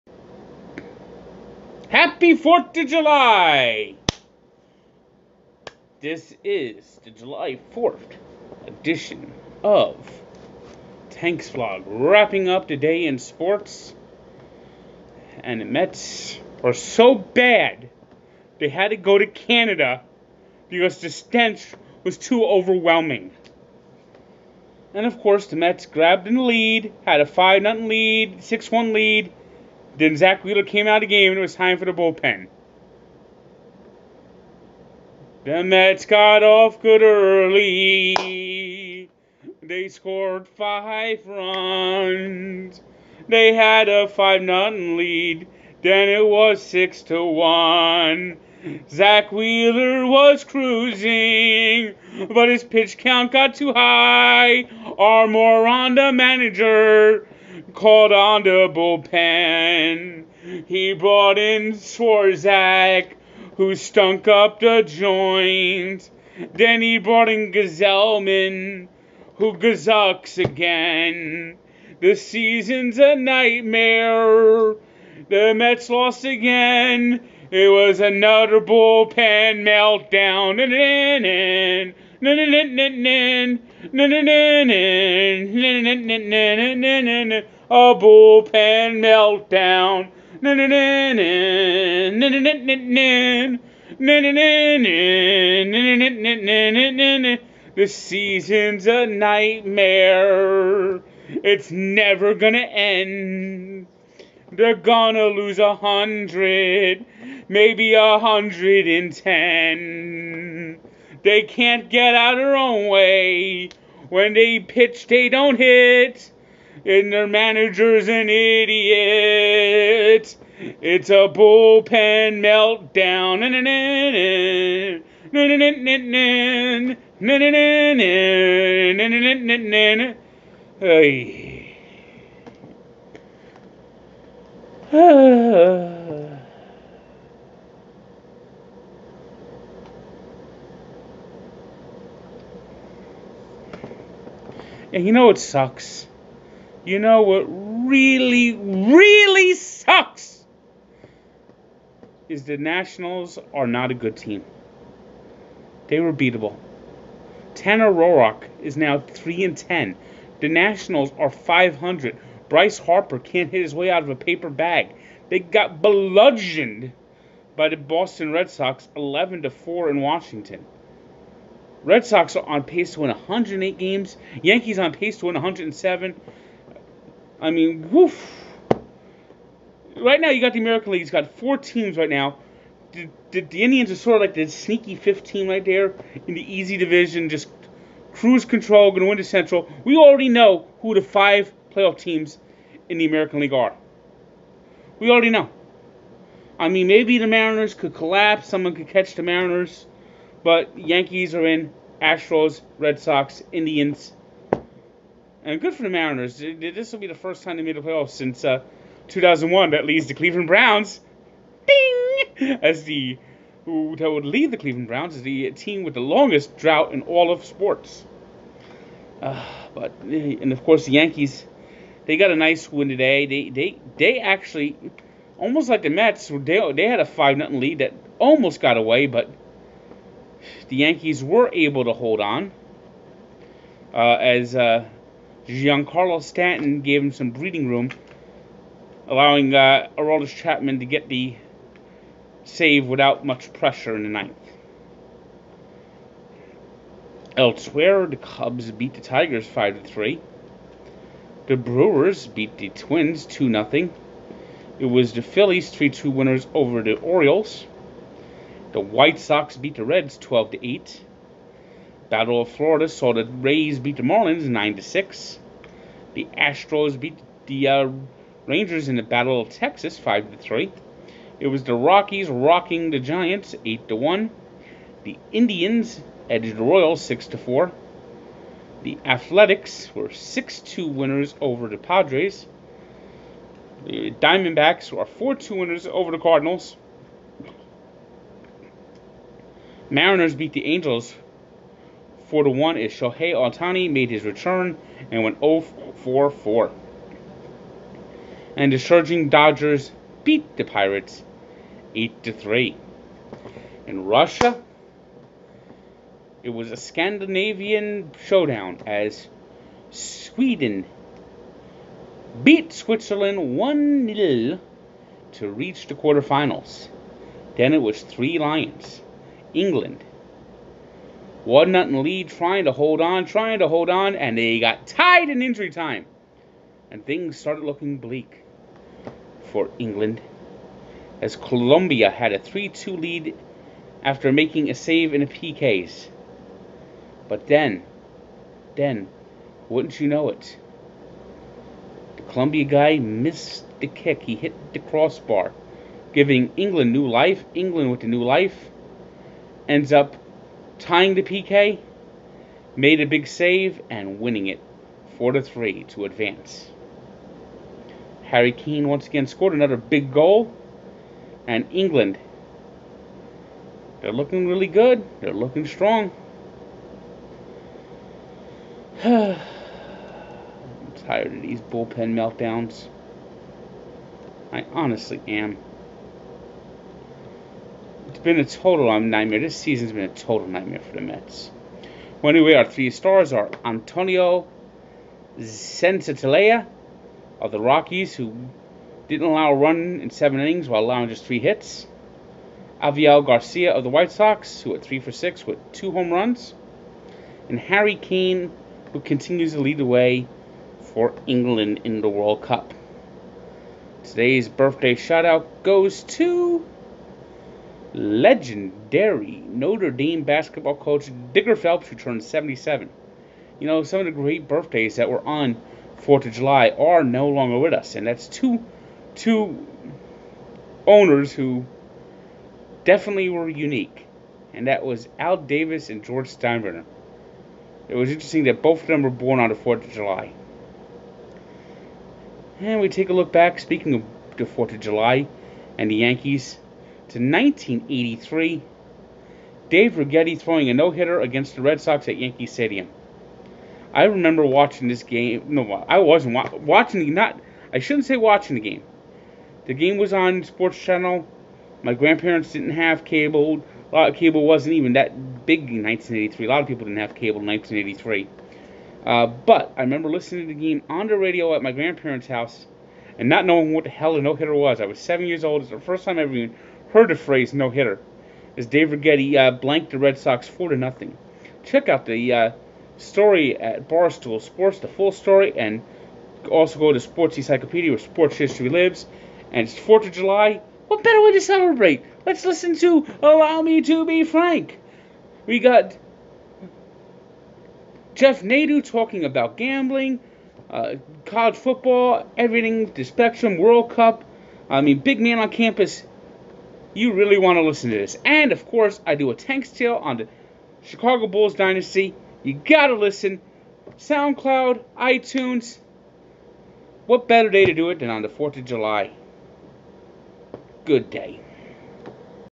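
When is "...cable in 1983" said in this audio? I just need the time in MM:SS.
07:37.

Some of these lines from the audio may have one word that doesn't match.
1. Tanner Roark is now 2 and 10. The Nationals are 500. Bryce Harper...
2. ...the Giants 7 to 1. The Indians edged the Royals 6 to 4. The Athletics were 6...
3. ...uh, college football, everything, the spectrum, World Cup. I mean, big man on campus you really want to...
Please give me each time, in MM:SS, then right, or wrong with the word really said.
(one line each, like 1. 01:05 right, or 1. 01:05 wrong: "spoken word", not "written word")
1. 02:37 wrong: "3", not "2"
2. 04:32 wrong: "8", not "7"
3. 08:10 right.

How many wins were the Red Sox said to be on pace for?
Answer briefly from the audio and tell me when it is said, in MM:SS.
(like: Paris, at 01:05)
108, at 02:53.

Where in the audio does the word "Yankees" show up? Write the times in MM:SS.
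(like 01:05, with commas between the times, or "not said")
02:54, 03:20, 03:40, 03:50, 07:15, 07:22.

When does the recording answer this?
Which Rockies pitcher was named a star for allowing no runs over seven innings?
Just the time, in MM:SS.
06:23.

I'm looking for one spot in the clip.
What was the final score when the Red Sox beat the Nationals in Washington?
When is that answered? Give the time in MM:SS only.
02:48.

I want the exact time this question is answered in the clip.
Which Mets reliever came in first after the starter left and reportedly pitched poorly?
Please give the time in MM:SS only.
01:01.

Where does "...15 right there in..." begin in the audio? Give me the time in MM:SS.
03:04.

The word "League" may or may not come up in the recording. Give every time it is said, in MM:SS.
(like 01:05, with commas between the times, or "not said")
03:00, 03:13.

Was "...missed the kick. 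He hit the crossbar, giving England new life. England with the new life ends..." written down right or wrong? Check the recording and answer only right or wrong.
right.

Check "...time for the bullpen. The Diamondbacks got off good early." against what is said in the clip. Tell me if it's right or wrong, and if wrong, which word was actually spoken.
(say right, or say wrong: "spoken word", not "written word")
wrong: "Mets", not "Diamondbacks".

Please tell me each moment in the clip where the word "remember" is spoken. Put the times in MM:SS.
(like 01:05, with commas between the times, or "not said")
07:24, 07:39.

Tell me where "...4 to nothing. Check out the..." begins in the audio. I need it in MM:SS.
07:50.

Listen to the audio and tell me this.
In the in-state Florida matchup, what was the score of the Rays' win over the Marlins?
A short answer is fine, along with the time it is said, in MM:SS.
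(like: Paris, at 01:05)
9 6, at 04:24.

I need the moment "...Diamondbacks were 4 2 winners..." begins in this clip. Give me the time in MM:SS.
04:44.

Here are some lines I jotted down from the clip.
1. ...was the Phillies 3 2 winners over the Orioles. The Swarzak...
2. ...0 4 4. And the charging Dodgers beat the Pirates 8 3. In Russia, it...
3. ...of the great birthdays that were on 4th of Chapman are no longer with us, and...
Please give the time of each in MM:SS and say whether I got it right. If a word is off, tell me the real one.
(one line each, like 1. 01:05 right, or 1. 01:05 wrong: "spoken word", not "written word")
1. 04:14 wrong: "White", not "Swarzak"
2. 04:55 right
3. 06:53 wrong: "July", not "Chapman".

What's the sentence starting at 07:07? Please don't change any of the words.
It was interesting that both of them were born on the 4th of July.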